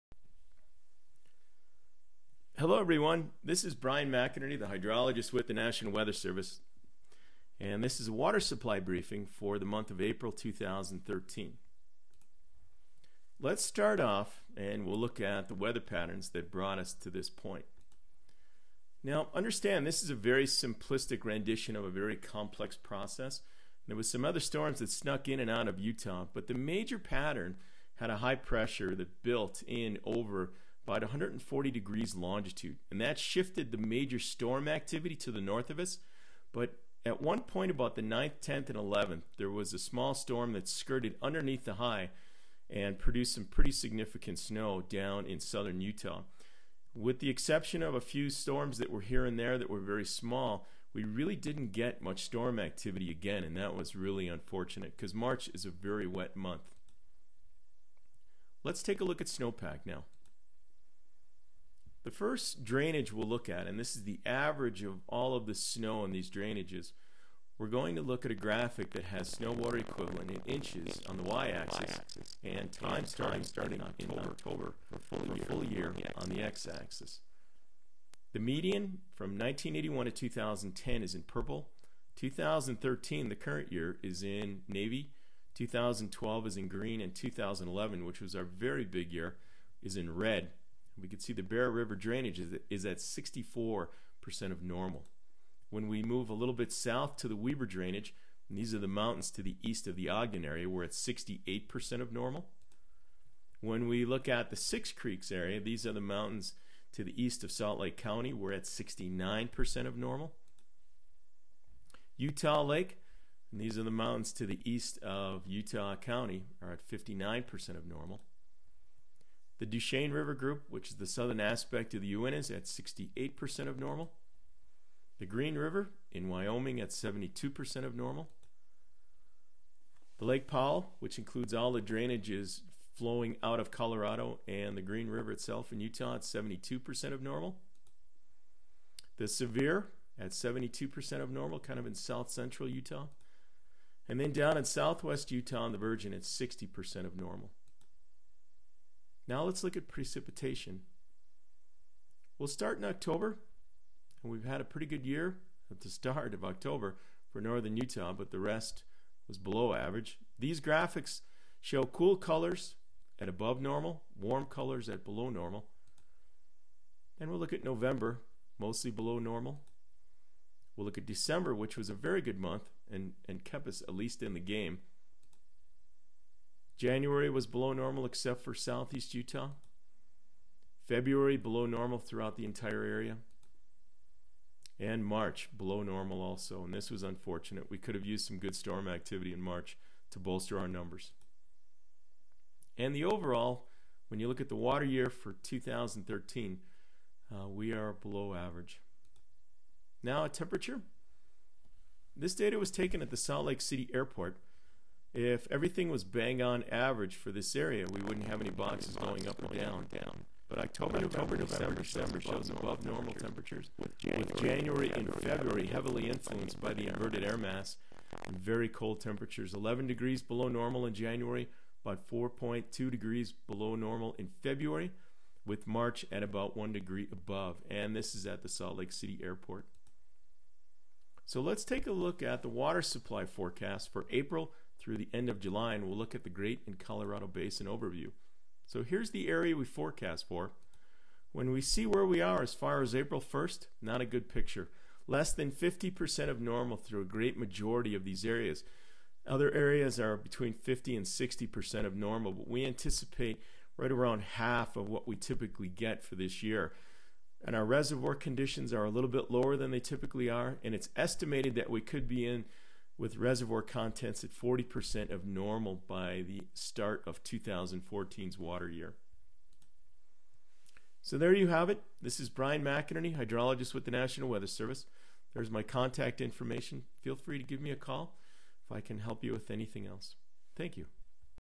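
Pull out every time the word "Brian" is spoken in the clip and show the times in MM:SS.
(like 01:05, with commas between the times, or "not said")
00:03, 04:32.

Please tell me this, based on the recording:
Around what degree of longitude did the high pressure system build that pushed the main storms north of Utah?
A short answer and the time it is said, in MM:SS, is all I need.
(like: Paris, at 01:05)
140, at 00:30.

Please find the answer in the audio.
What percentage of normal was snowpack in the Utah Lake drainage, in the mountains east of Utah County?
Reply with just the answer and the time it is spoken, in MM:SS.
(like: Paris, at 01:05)
59%, at 01:56.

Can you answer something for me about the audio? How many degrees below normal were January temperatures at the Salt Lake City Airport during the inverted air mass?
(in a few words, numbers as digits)
11.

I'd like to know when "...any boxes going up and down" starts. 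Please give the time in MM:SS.
03:28.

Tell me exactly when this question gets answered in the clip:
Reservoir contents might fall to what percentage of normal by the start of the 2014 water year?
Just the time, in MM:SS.
04:24.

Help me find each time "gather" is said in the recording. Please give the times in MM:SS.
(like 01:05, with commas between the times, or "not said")
not said.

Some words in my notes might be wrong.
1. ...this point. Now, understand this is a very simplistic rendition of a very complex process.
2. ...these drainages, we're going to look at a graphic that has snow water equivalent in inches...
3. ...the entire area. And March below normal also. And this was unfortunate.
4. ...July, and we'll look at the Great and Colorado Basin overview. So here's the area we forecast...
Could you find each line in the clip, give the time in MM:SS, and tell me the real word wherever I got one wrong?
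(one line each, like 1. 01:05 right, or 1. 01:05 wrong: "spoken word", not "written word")
1. 00:17 right
2. 01:06 right
3. 03:02 right
4. 03:55 right.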